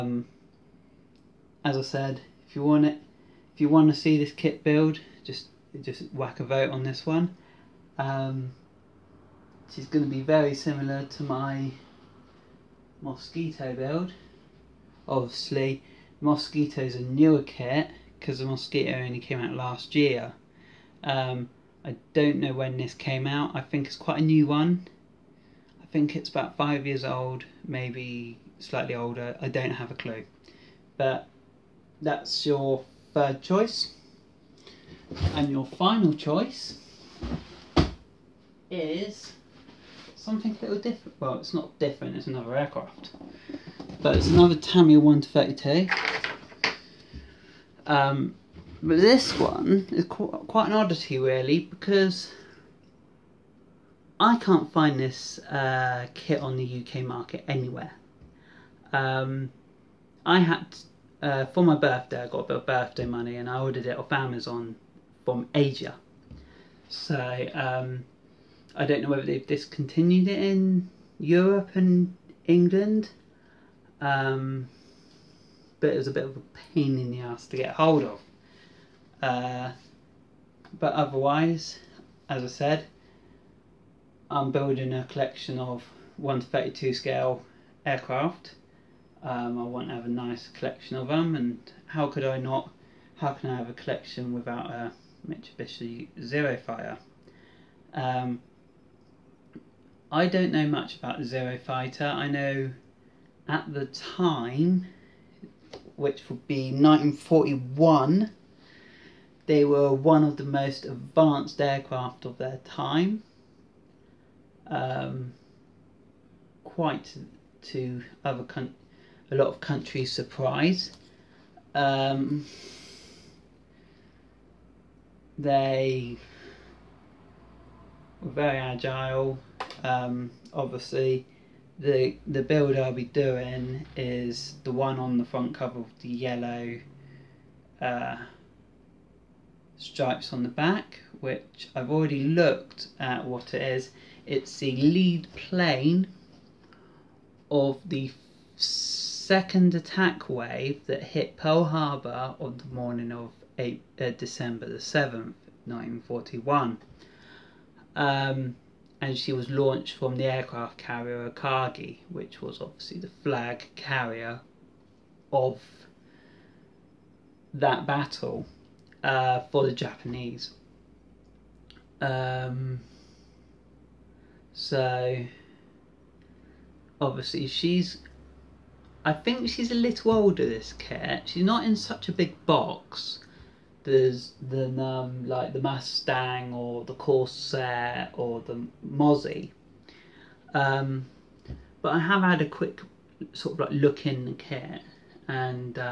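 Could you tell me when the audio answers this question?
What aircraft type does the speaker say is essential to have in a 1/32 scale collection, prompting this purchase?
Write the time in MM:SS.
01:35.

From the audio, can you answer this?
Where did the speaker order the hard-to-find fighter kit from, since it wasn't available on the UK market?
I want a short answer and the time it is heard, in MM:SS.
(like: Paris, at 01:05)
Asia, at 01:05.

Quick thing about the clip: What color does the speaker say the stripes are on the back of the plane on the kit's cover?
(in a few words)
Yellow.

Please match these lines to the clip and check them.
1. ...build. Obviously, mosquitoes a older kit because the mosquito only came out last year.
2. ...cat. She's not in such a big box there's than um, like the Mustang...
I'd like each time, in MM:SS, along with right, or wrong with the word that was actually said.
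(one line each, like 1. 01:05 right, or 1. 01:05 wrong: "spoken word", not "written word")
1. 00:13 wrong: "newer", not "older"
2. 03:00 right.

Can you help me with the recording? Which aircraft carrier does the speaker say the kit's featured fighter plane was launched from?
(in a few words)
Akagi.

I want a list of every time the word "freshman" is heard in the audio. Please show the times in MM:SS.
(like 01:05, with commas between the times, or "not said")
not said.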